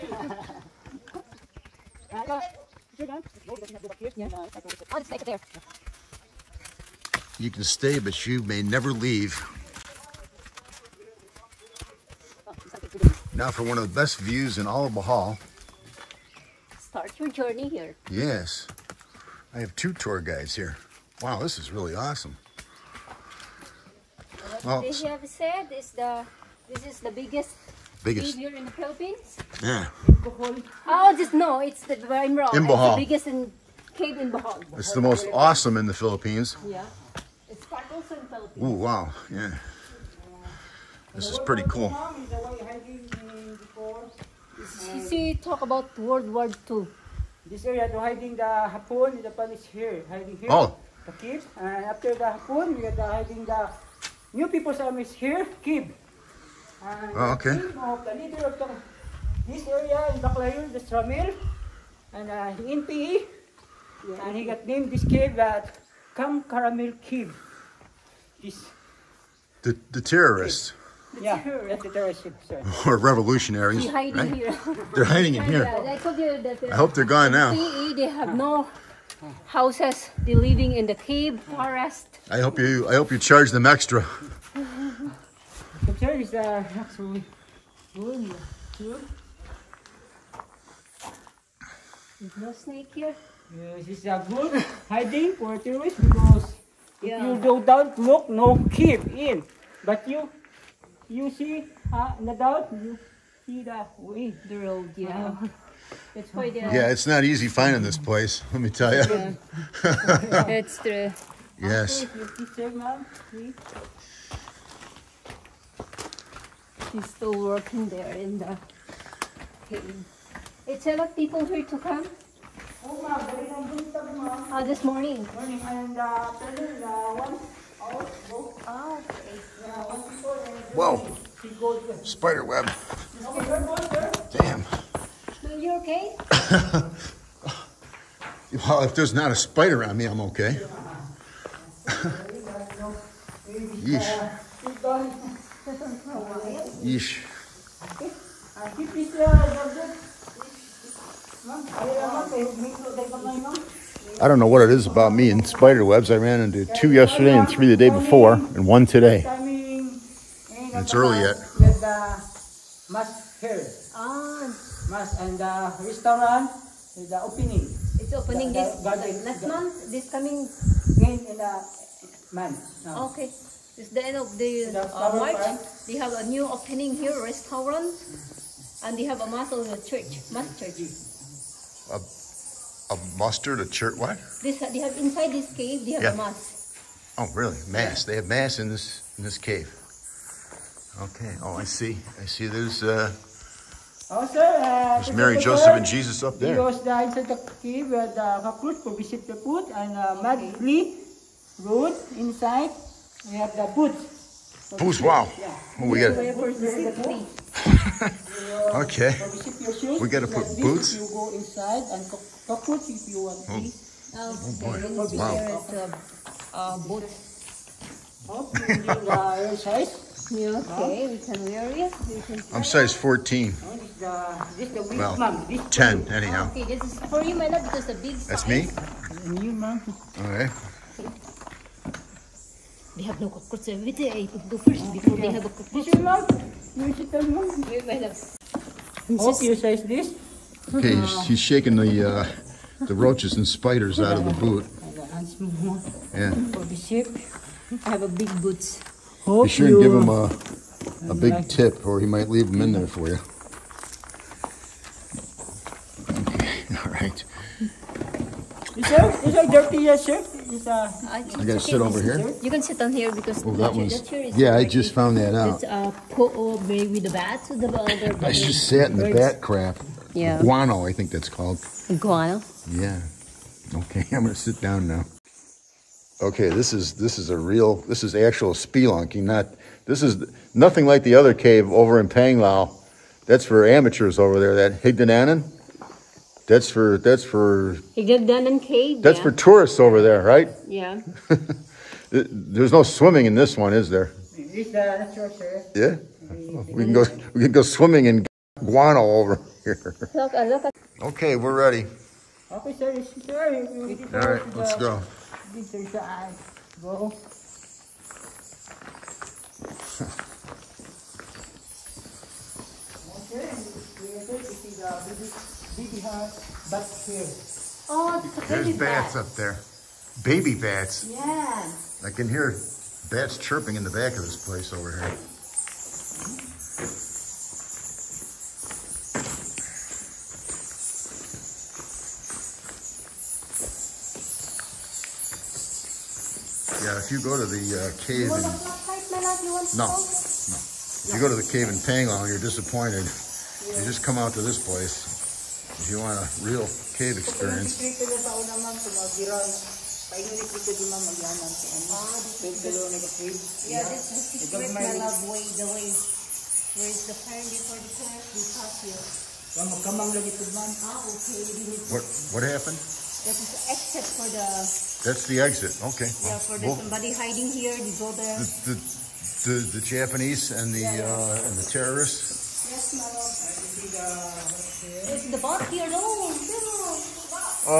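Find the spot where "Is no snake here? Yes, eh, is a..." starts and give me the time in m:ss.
1:32.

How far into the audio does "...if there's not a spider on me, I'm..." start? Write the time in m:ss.
2:18.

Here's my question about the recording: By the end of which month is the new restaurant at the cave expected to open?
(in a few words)
March.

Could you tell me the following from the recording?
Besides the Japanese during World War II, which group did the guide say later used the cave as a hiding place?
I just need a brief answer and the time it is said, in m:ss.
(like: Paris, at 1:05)
New People's Army, at 0:54.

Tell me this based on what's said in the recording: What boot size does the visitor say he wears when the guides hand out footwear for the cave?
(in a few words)
14.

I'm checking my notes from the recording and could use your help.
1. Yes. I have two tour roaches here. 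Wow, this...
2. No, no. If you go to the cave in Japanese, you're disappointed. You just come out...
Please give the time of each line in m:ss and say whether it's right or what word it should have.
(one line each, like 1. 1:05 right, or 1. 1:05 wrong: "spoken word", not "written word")
1. 0:18 wrong: "guides", not "roaches"
2. 5:39 wrong: "Panglao", not "Japanese".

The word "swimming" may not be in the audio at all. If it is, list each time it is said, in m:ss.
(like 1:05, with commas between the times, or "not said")
4:52, 4:57.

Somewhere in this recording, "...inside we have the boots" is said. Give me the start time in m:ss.
3:22.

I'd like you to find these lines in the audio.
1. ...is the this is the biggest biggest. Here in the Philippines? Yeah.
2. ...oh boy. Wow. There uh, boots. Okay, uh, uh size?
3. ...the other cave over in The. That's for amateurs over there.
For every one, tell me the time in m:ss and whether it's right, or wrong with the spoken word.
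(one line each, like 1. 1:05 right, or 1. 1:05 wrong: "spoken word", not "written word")
1. 0:25 right
2. 3:34 right
3. 4:41 wrong: "Panglao", not "The".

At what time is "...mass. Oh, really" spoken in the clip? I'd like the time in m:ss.
3:06.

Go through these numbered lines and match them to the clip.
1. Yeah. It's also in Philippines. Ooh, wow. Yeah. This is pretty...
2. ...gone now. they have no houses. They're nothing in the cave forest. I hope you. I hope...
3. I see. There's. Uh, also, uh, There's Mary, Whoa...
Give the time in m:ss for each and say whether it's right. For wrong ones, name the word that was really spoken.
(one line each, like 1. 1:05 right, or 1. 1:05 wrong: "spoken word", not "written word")
1. 0:36 right
2. 1:17 wrong: "living", not "nothing"
3. 3:12 wrong: "Joseph", not "Whoa".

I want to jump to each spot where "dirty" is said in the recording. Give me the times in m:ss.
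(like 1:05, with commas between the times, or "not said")
4:19.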